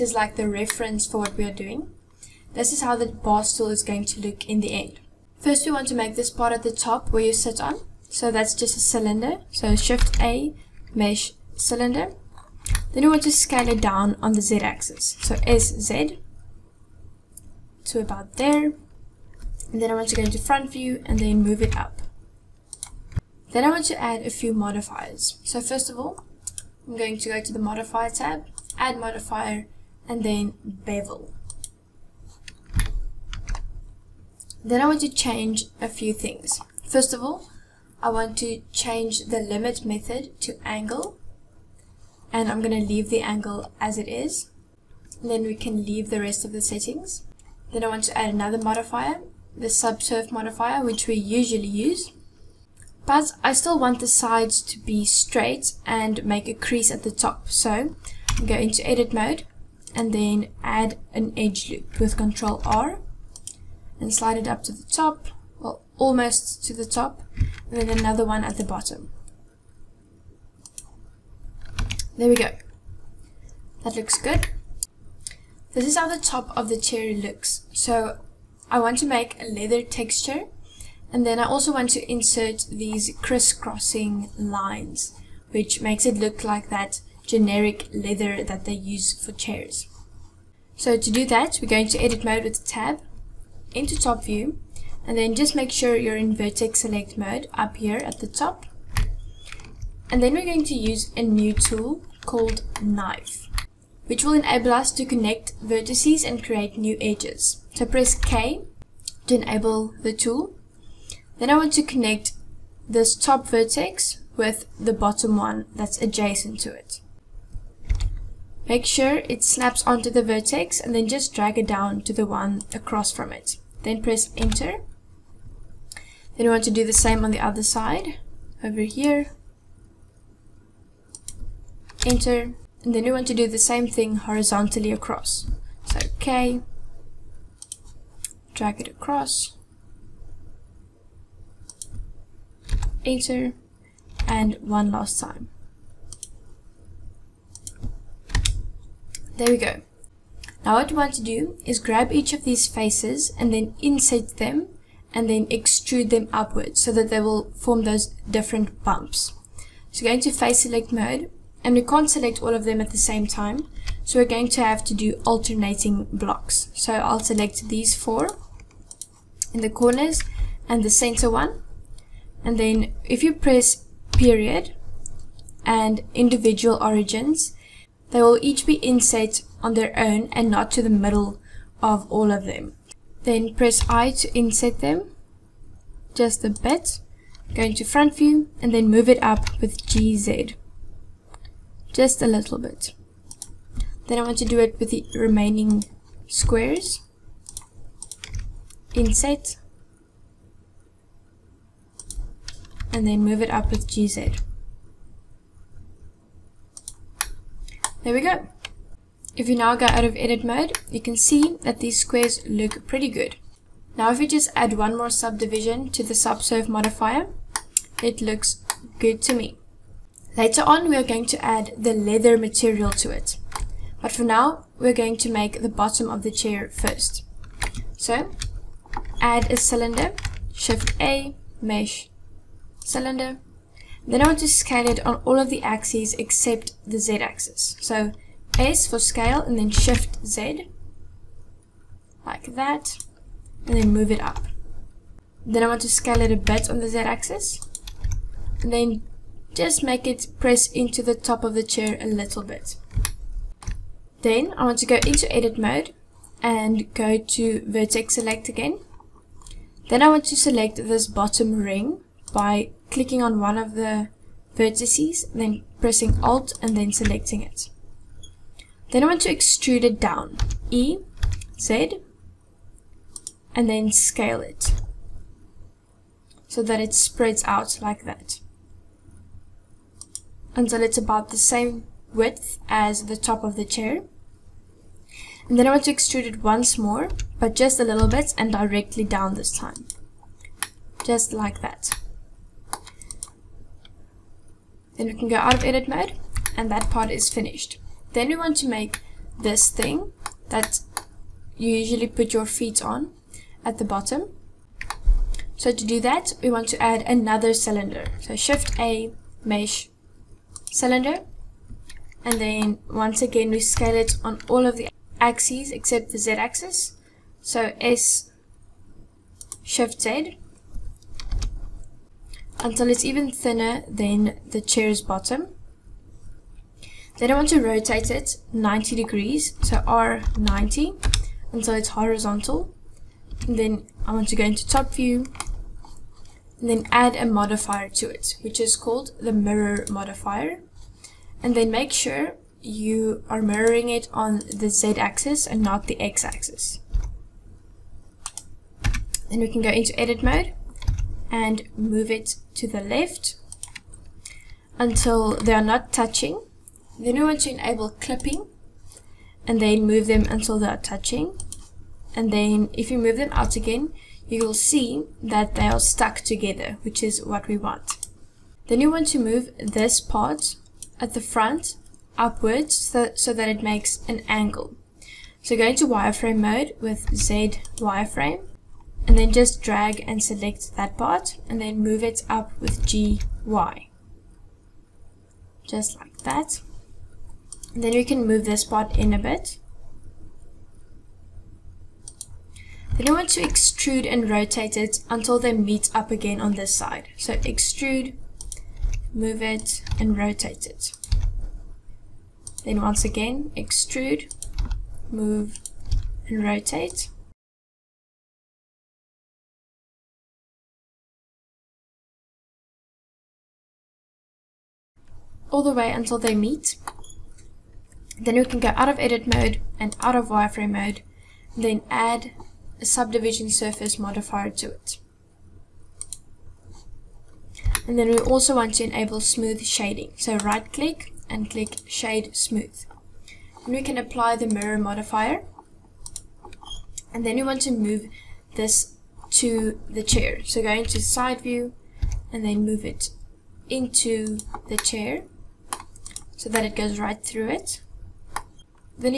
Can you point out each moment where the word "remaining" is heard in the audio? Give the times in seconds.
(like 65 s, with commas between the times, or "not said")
195 s.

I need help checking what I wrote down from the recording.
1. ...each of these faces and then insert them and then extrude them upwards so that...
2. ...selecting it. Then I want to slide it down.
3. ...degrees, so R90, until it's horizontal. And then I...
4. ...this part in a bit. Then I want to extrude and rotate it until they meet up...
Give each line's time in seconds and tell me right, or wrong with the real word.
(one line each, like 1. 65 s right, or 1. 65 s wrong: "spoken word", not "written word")
1. 152 s right
2. 266 s wrong: "extrude", not "slide"
3. 328 s right
4. 388 s right.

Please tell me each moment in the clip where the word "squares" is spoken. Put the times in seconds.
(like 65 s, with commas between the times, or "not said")
196 s, 211 s.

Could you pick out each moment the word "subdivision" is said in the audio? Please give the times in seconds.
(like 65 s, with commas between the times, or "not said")
215 s, 422 s.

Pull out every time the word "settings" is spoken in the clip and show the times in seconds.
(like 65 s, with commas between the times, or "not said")
46 s.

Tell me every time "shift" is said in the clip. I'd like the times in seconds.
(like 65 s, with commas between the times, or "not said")
9 s, 230 s, 239 s, 308 s, 319 s.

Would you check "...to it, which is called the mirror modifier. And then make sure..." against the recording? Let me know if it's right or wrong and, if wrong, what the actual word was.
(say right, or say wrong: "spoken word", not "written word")
right.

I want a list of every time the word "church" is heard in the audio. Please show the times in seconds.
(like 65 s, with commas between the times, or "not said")
not said.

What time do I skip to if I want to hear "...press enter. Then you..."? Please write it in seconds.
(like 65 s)
123 s.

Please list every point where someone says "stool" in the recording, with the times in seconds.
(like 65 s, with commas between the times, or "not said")
3 s.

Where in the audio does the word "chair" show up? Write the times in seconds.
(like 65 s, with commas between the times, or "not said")
89 s, 226 s, 251 s, 283 s, 324 s, 440 s, 444 s.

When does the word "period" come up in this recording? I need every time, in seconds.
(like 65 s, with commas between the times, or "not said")
174 s.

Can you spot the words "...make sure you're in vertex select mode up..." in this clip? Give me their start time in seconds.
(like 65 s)
95 s.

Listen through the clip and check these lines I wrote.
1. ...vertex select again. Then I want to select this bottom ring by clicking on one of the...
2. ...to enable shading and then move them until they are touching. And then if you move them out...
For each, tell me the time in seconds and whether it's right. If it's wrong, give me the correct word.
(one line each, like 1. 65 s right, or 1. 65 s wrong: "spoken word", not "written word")
1. 257 s right
2. 357 s wrong: "clipping", not "shading".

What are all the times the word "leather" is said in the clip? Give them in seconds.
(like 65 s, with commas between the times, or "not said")
79 s, 87 s, 221 s.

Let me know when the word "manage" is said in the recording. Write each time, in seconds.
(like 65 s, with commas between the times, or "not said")
not said.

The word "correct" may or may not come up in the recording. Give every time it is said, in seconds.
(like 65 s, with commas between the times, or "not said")
not said.